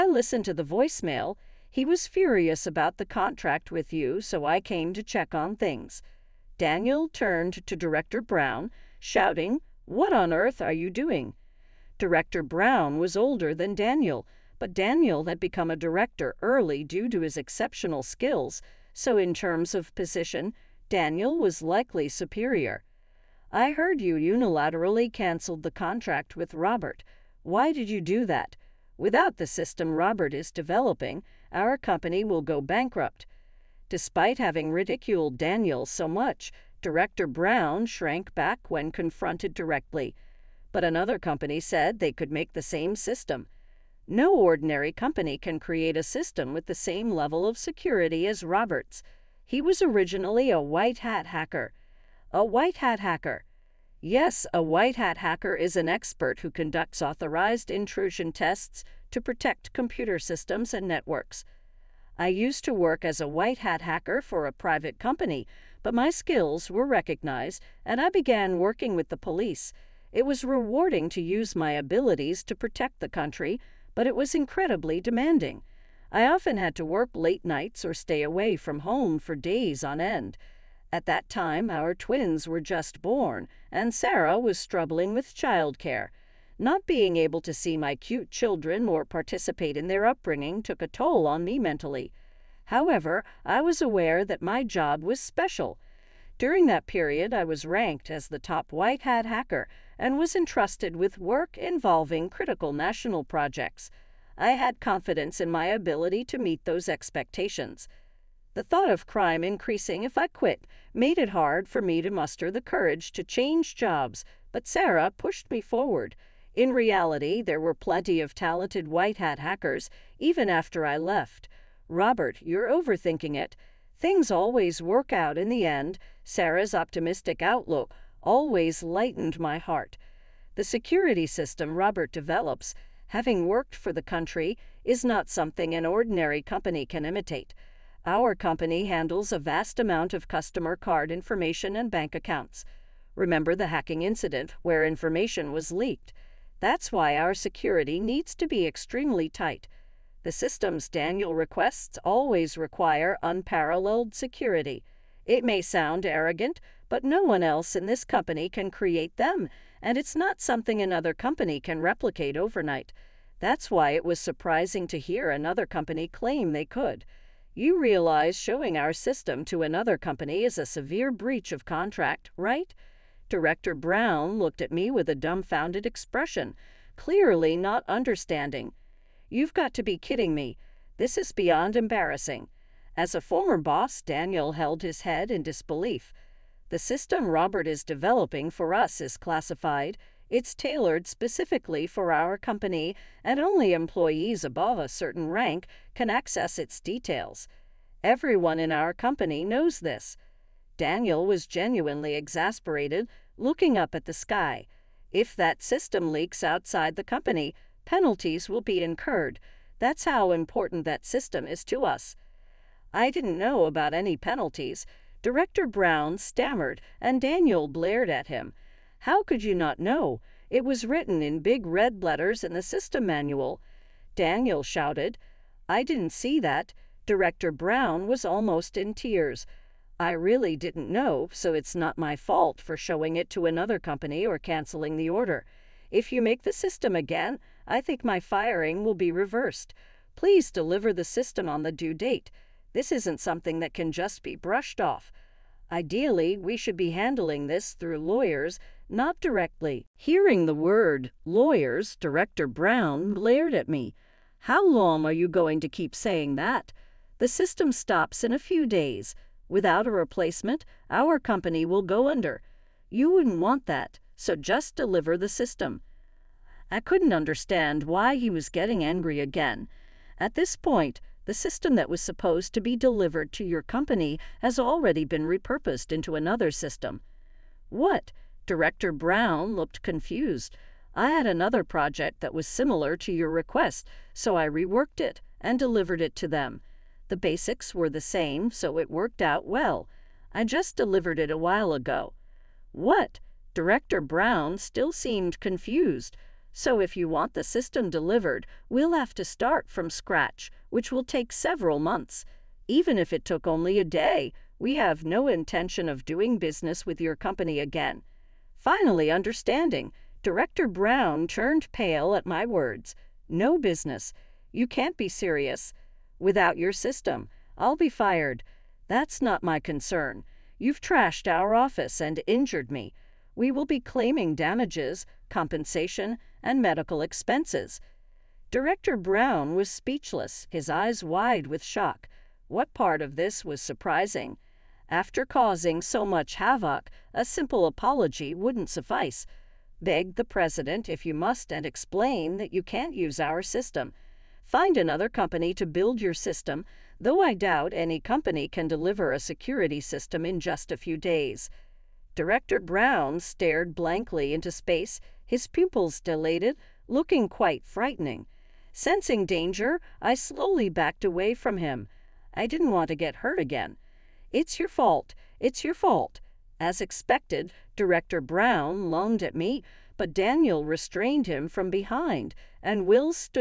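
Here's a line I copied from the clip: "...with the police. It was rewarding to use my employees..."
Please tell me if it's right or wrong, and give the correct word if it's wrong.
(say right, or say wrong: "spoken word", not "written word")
wrong: "abilities", not "employees".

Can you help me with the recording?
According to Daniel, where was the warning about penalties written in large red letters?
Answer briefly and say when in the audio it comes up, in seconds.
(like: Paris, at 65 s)
system manual, at 222 s.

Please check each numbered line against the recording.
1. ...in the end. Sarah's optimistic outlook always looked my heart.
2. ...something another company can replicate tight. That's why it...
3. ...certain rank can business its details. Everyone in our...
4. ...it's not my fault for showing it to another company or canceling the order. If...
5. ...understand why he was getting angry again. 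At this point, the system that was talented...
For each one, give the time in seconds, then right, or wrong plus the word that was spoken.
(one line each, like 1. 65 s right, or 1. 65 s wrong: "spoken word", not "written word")
1. 125 s wrong: "lightened", not "looked"
2. 160 s wrong: "overnight", not "tight"
3. 194 s wrong: "access", not "business"
4. 231 s right
5. 267 s wrong: "supposed", not "talented".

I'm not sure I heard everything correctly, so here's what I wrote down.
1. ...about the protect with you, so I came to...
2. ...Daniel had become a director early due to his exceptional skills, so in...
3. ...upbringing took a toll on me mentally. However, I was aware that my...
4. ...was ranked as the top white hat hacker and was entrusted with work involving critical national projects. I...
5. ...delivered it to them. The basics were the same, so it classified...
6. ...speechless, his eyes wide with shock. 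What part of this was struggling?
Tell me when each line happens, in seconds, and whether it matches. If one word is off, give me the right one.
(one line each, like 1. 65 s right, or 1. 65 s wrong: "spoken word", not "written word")
1. 2 s wrong: "contract", not "protect"
2. 14 s right
3. 90 s right
4. 97 s right
5. 285 s wrong: "worked", not "classified"
6. 329 s wrong: "surprising", not "struggling".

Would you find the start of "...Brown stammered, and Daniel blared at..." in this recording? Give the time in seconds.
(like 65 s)
215 s.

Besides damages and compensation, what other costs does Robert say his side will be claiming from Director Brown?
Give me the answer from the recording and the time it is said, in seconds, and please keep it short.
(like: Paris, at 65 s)
medical expenses, at 326 s.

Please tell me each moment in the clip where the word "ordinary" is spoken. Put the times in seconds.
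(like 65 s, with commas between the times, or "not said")
44 s, 135 s.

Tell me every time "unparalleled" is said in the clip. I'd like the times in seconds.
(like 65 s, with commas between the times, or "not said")
153 s.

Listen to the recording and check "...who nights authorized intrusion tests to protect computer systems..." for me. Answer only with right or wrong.
wrong.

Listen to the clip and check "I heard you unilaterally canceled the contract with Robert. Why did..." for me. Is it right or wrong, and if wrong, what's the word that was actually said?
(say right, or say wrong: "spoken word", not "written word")
right.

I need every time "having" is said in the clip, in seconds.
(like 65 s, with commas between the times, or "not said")
34 s, 133 s.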